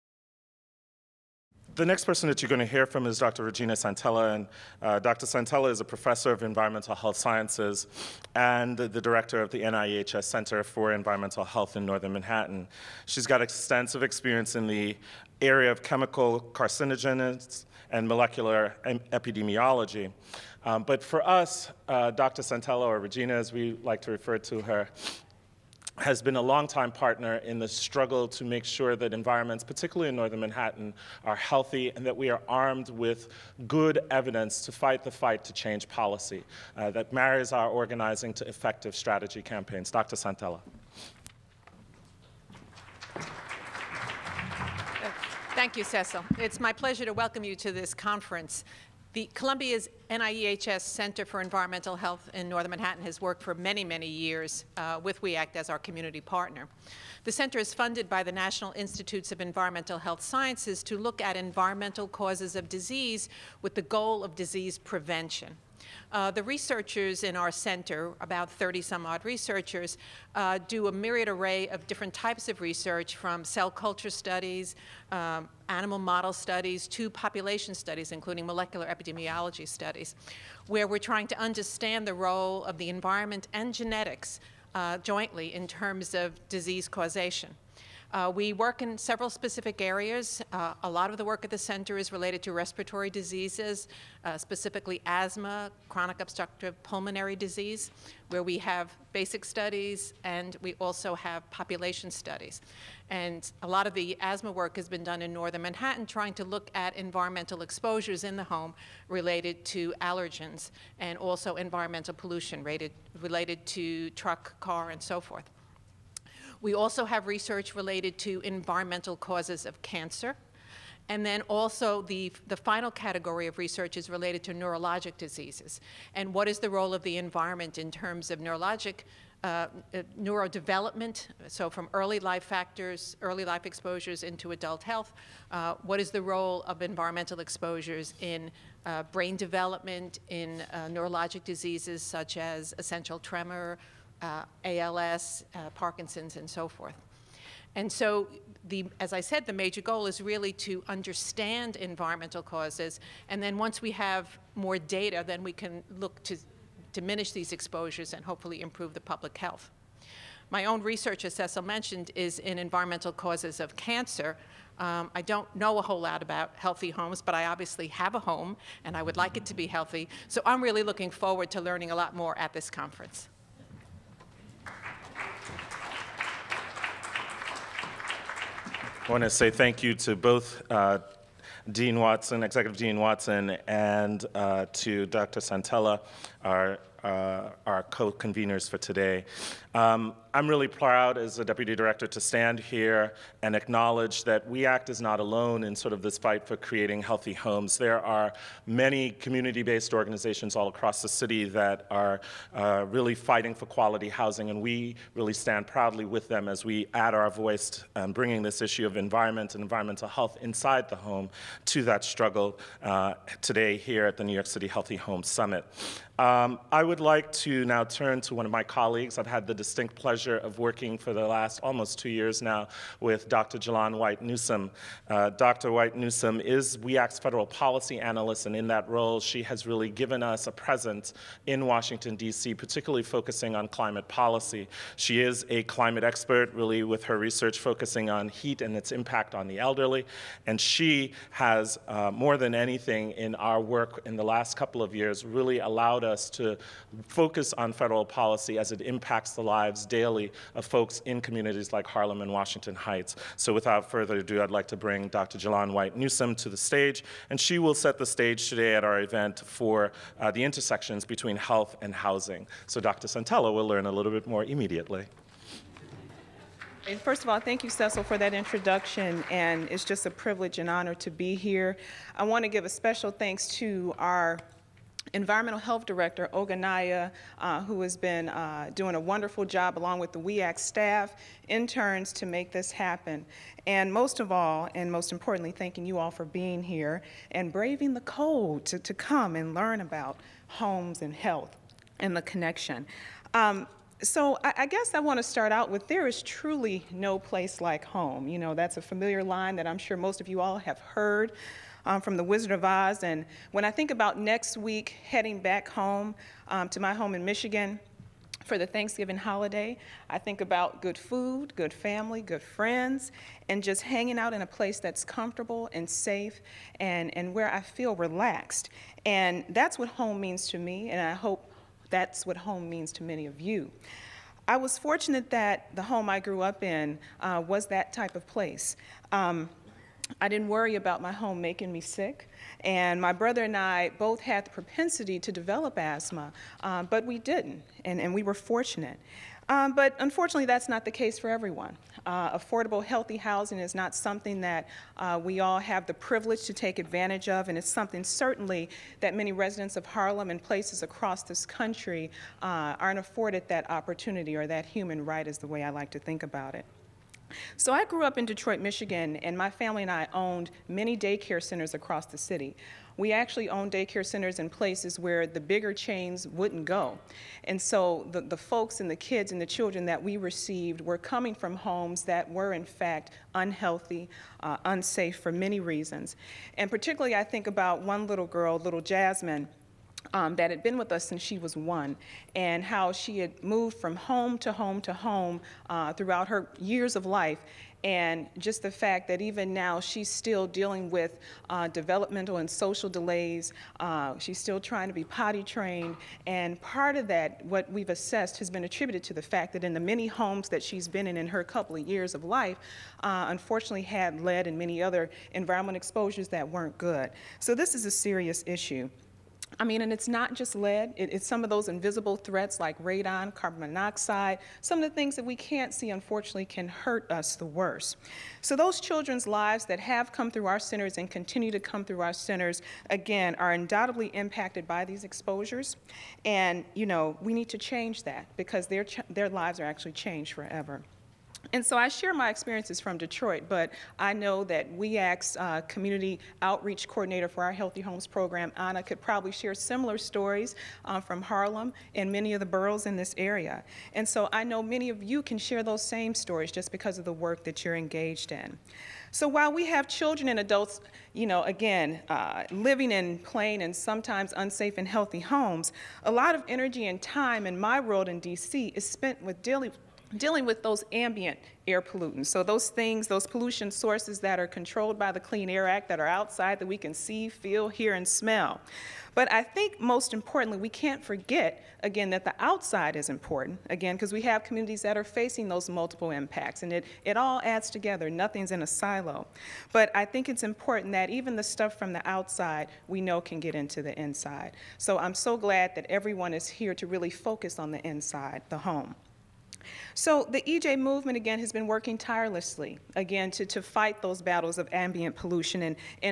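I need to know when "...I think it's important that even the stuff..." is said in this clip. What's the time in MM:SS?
07:59.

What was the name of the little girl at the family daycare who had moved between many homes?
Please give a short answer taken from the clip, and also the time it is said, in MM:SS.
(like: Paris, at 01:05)
Jasmine, at 06:18.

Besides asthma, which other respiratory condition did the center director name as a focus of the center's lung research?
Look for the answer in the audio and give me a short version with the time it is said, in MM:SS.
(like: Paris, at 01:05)
Chronic obstructive pulmonary disease, at 01:35.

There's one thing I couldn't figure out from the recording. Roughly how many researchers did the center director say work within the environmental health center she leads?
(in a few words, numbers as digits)
30.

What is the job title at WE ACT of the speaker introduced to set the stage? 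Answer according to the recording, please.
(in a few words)
Federal policy analyst.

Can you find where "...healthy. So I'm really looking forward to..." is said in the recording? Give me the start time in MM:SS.
02:49.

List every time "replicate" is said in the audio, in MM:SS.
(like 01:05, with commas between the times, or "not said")
not said.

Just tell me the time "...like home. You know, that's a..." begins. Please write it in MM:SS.
04:57.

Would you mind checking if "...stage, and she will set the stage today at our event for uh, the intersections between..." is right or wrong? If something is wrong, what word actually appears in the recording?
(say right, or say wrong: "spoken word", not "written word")
right.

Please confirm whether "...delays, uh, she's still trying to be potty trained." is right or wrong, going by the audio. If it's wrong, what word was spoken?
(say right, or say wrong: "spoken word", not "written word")
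right.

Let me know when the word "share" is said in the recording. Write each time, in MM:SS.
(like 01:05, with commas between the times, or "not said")
07:11, 07:19, 07:25.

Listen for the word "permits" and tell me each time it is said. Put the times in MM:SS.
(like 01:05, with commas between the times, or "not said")
not said.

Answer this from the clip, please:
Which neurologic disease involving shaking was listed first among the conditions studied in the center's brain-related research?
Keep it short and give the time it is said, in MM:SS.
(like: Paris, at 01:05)
Essential tremor, at 02:22.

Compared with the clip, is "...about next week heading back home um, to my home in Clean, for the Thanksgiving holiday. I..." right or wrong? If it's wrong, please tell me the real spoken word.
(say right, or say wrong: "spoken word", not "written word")
wrong: "Michigan", not "Clean".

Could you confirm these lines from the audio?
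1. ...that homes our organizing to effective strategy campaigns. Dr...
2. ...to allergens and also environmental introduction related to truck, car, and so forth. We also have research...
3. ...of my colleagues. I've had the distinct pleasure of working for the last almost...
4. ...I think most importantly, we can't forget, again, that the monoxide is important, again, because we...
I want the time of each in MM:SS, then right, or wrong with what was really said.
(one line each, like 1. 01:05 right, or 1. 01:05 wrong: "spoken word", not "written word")
1. 00:36 wrong: "marries", not "homes"
2. 01:49 wrong: "pollution", not "introduction"
3. 03:38 right
4. 07:49 wrong: "outside", not "monoxide".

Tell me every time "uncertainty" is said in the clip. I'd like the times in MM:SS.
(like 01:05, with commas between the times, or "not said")
not said.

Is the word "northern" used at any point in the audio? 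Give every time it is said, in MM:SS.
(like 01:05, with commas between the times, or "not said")
00:11, 00:30, 00:52, 01:45.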